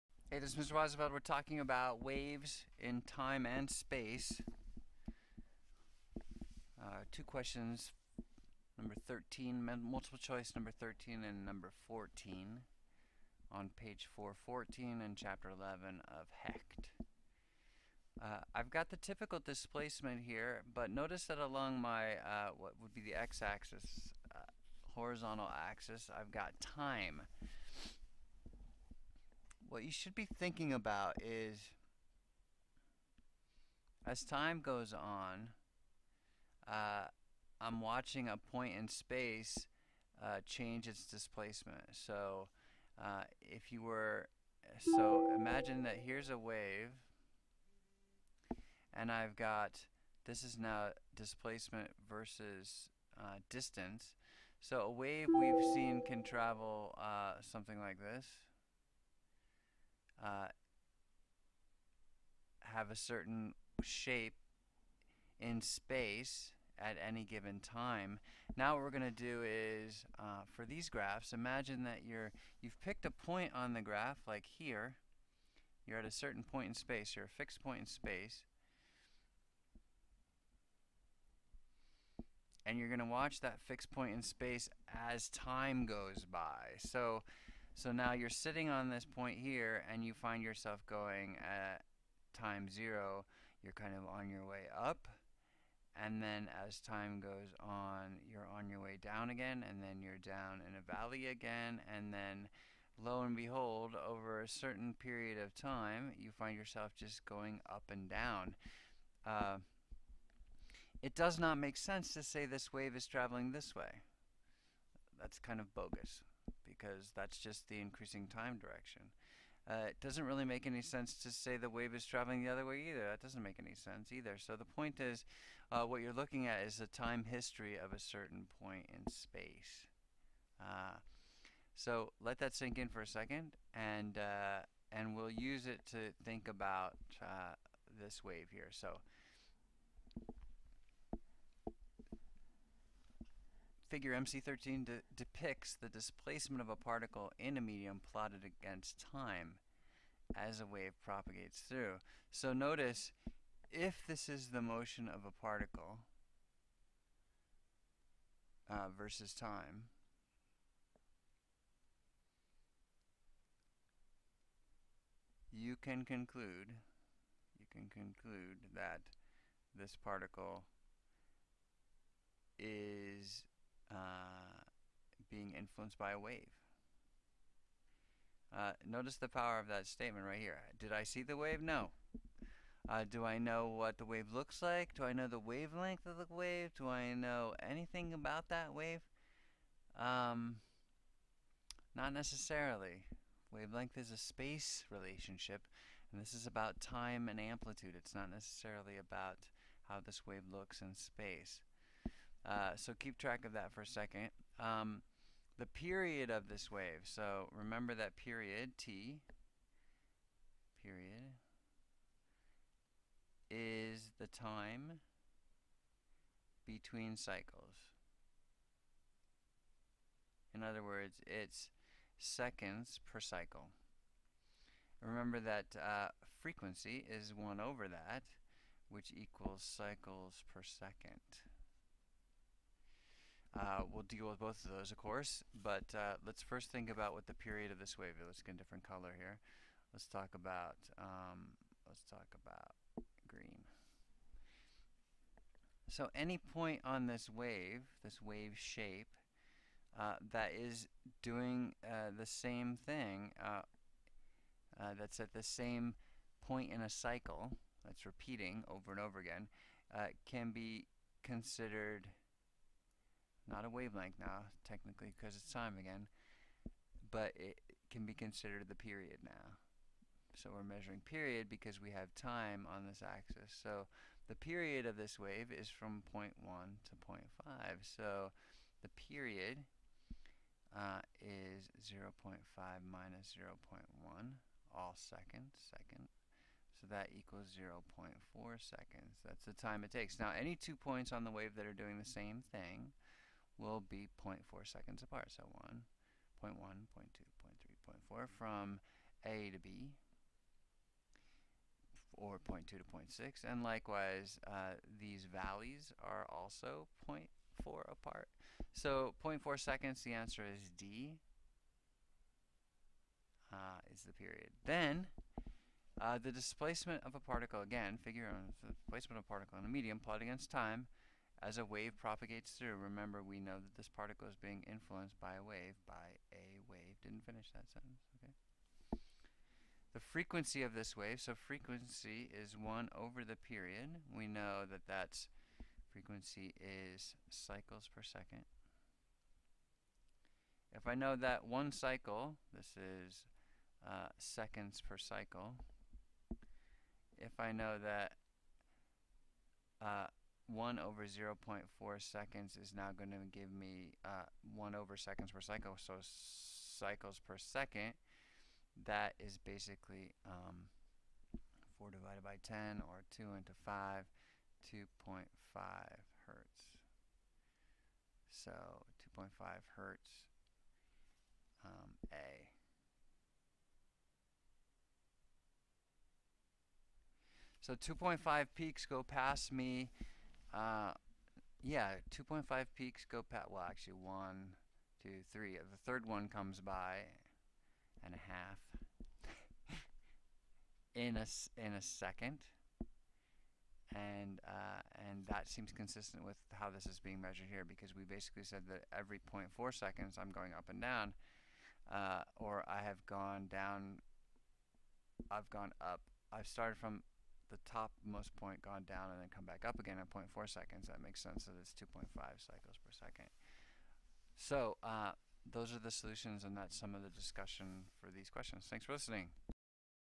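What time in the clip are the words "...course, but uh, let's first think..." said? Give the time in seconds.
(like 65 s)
234 s.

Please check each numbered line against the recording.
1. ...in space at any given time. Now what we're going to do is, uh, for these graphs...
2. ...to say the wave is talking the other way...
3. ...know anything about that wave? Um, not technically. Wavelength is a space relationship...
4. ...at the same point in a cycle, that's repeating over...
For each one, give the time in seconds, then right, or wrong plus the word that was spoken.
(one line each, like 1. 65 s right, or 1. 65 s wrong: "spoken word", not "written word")
1. 65 s right
2. 121 s wrong: "traveling", not "talking"
3. 187 s wrong: "necessarily", not "technically"
4. 255 s right.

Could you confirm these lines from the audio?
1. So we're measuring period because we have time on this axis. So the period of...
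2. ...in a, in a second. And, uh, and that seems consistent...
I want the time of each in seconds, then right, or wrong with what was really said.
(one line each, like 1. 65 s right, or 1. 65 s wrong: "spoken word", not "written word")
1. 270 s right
2. 390 s right.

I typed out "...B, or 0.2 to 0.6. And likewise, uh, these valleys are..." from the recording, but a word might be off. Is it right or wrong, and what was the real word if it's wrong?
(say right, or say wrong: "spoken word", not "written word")
right.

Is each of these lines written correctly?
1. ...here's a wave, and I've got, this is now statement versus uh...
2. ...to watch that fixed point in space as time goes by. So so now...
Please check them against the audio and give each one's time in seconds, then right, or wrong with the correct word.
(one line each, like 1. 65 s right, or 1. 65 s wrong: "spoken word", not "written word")
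1. 46 s wrong: "displacement", not "statement"
2. 82 s right.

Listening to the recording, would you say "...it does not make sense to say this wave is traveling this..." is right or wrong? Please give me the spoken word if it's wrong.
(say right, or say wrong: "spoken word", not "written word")
right.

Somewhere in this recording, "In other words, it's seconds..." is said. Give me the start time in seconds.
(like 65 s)
220 s.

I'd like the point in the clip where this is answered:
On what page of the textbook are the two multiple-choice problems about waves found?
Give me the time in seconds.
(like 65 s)
13 s.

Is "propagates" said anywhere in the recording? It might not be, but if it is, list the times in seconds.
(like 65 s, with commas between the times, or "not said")
151 s, 321 s.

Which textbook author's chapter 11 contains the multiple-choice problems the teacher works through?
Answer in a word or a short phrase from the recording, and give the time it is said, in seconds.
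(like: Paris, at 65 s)
Hecht, at 16 s.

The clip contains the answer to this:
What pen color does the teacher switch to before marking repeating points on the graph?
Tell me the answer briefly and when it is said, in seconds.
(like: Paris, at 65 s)
green, at 243 s.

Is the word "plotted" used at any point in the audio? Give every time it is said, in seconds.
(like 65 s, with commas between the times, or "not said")
148 s, 319 s.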